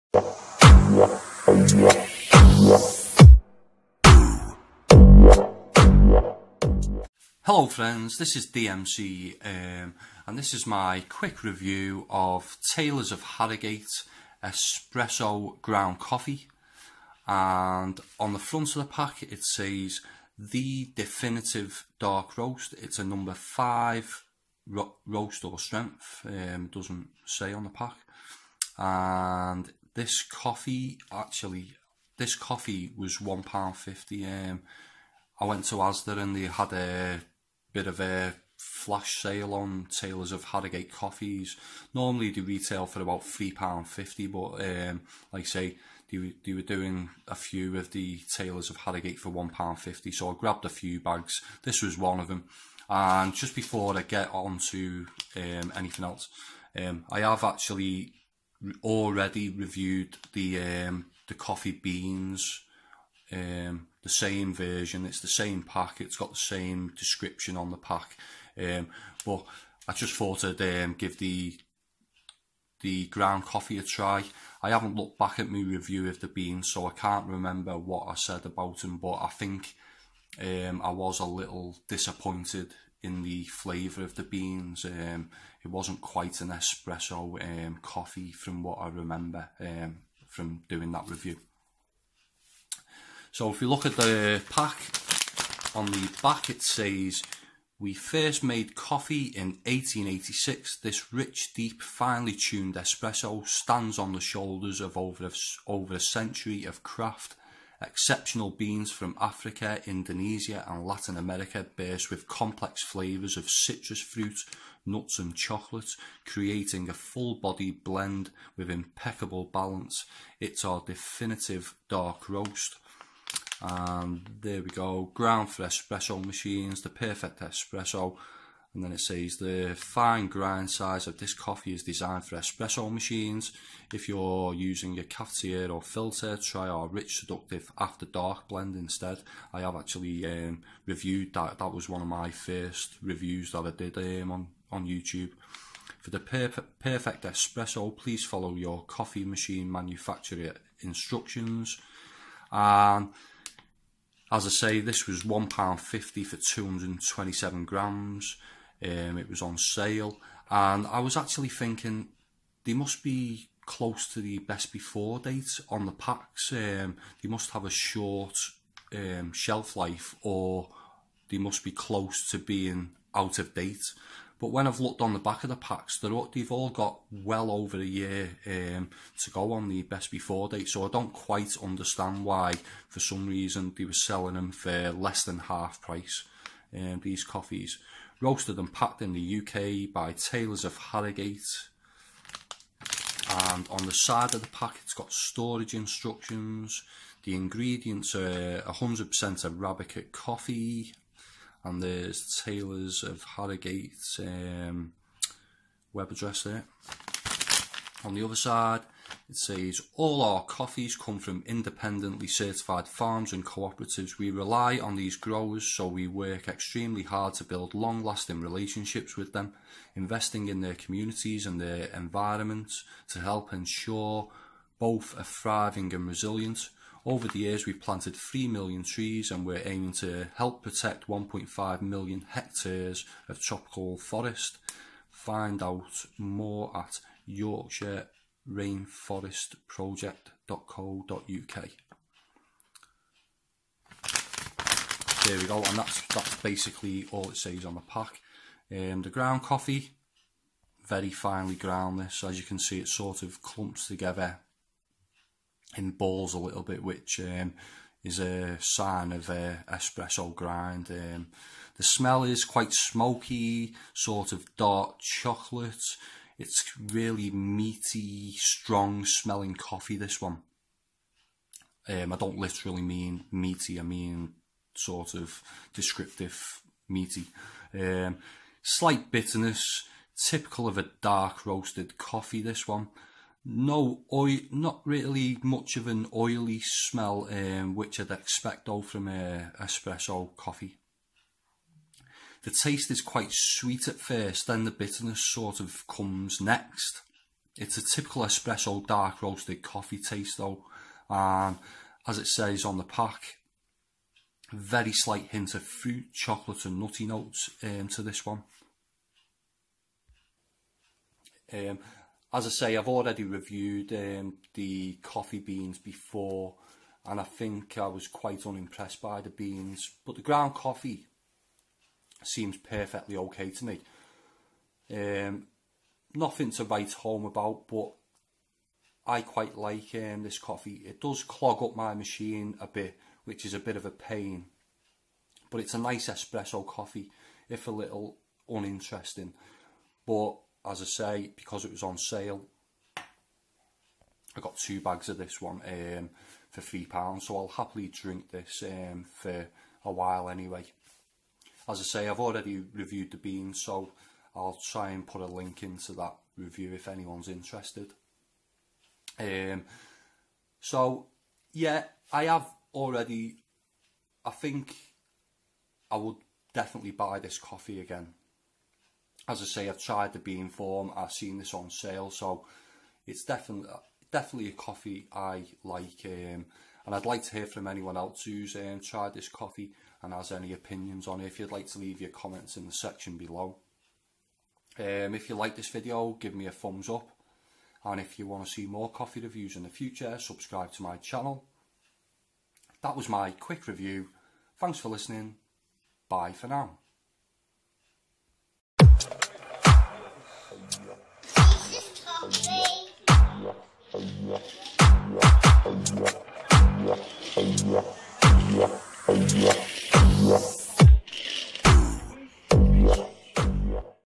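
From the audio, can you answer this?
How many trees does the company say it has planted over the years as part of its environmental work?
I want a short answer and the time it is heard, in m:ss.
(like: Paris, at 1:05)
3 million, at 3:48.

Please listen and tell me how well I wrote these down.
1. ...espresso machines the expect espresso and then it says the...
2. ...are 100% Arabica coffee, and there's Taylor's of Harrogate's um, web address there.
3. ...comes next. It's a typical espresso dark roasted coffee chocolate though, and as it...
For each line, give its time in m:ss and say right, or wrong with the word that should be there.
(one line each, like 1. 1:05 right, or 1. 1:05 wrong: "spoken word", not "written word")
1. 2:05 wrong: "perfect", not "expect"
2. 3:18 right
3. 4:55 wrong: "taste", not "chocolate".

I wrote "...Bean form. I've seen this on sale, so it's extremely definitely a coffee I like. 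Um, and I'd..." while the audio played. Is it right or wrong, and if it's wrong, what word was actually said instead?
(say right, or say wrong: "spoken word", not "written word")
wrong: "definitely", not "extremely".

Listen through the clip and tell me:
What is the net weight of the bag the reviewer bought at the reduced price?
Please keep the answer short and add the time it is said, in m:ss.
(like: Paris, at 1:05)
227 grams, at 2:36.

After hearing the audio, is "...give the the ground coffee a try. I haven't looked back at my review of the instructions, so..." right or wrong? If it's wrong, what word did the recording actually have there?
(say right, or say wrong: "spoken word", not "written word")
wrong: "beans", not "instructions".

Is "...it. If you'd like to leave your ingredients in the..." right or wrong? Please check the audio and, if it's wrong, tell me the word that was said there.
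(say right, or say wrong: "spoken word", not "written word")
wrong: "comments", not "ingredients".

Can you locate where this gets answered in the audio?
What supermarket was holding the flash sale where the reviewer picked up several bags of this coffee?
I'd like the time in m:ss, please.
0:35.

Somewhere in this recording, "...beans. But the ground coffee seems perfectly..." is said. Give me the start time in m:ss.
5:19.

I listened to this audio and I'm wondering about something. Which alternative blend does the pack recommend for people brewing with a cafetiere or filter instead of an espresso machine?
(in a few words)
After Dark.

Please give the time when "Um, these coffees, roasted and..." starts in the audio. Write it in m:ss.
3:06.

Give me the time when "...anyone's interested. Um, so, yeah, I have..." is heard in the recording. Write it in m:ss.
5:56.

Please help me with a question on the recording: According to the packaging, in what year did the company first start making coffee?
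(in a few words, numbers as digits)
1886.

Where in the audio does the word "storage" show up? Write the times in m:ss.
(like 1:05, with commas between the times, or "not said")
3:15.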